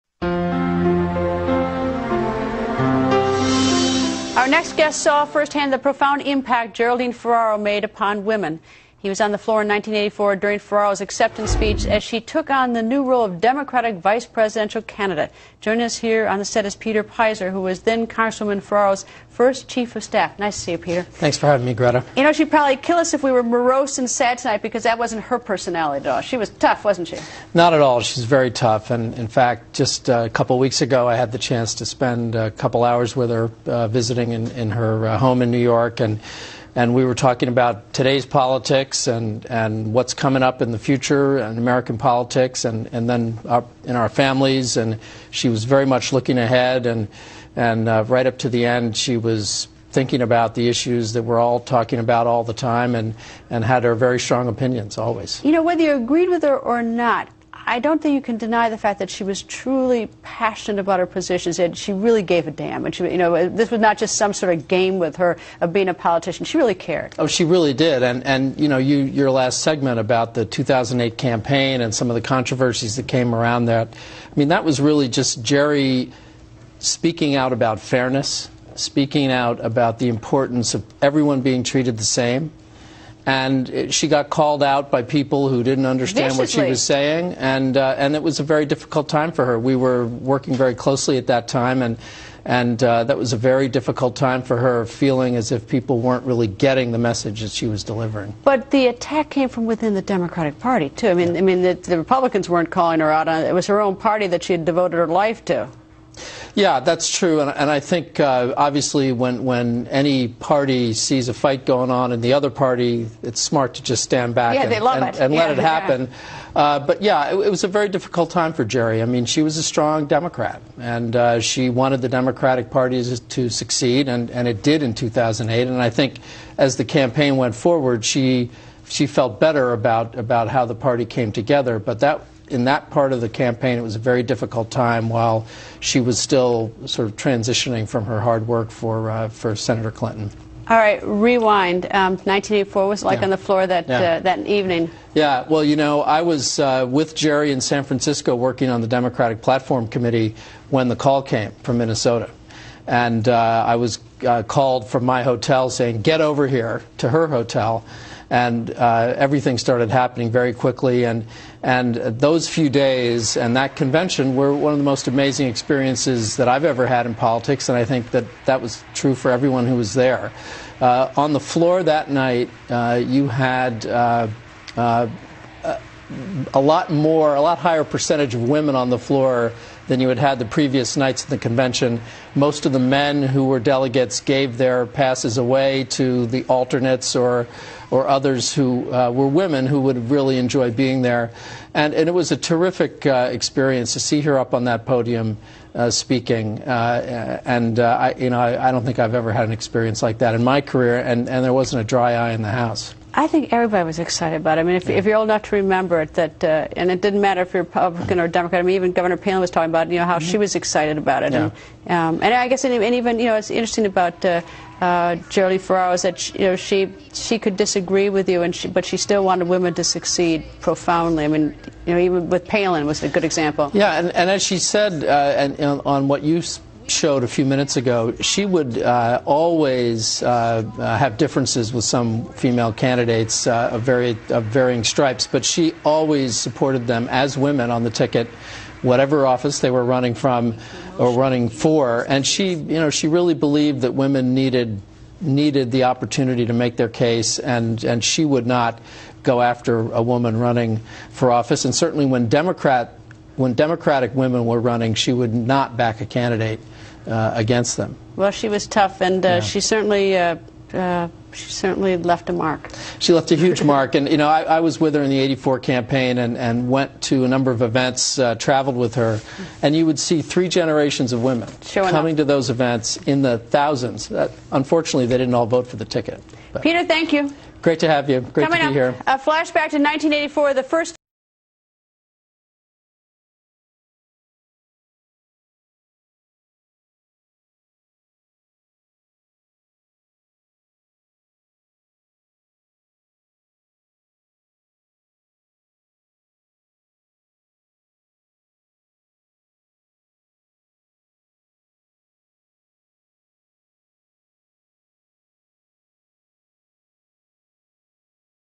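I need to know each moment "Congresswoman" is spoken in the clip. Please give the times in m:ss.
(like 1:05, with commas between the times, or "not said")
0:18.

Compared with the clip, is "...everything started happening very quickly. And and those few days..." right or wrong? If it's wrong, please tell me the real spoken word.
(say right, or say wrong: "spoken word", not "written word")
right.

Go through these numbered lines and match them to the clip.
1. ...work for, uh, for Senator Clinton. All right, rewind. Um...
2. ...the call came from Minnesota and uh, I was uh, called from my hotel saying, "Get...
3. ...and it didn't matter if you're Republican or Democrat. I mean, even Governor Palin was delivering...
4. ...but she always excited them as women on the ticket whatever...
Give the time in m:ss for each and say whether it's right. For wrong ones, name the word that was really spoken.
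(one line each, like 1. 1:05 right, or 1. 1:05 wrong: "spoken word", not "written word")
1. 2:18 right
2. 2:30 right
3. 3:26 wrong: "talking", not "delivering"
4. 3:55 wrong: "supported", not "excited".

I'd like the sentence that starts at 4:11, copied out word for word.
And certainly when Democrat when Democratic women were running, she would not back a candidate uh, against them.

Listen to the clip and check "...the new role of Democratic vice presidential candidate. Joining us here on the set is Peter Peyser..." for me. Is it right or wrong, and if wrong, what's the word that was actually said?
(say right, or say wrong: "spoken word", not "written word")
right.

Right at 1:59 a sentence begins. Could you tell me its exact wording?
I mean, she was a strong Democrat, and uh, she wanted the Democratic Party to succeed, and, and it did in 2008.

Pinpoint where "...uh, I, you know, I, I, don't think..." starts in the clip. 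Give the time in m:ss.
3:17.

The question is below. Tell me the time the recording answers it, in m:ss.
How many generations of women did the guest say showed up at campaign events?
4:30.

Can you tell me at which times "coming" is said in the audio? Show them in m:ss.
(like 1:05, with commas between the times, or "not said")
0:40, 4:31, 4:38.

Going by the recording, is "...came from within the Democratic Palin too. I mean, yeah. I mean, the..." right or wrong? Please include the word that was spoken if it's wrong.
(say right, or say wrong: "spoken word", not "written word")
wrong: "Party", not "Palin".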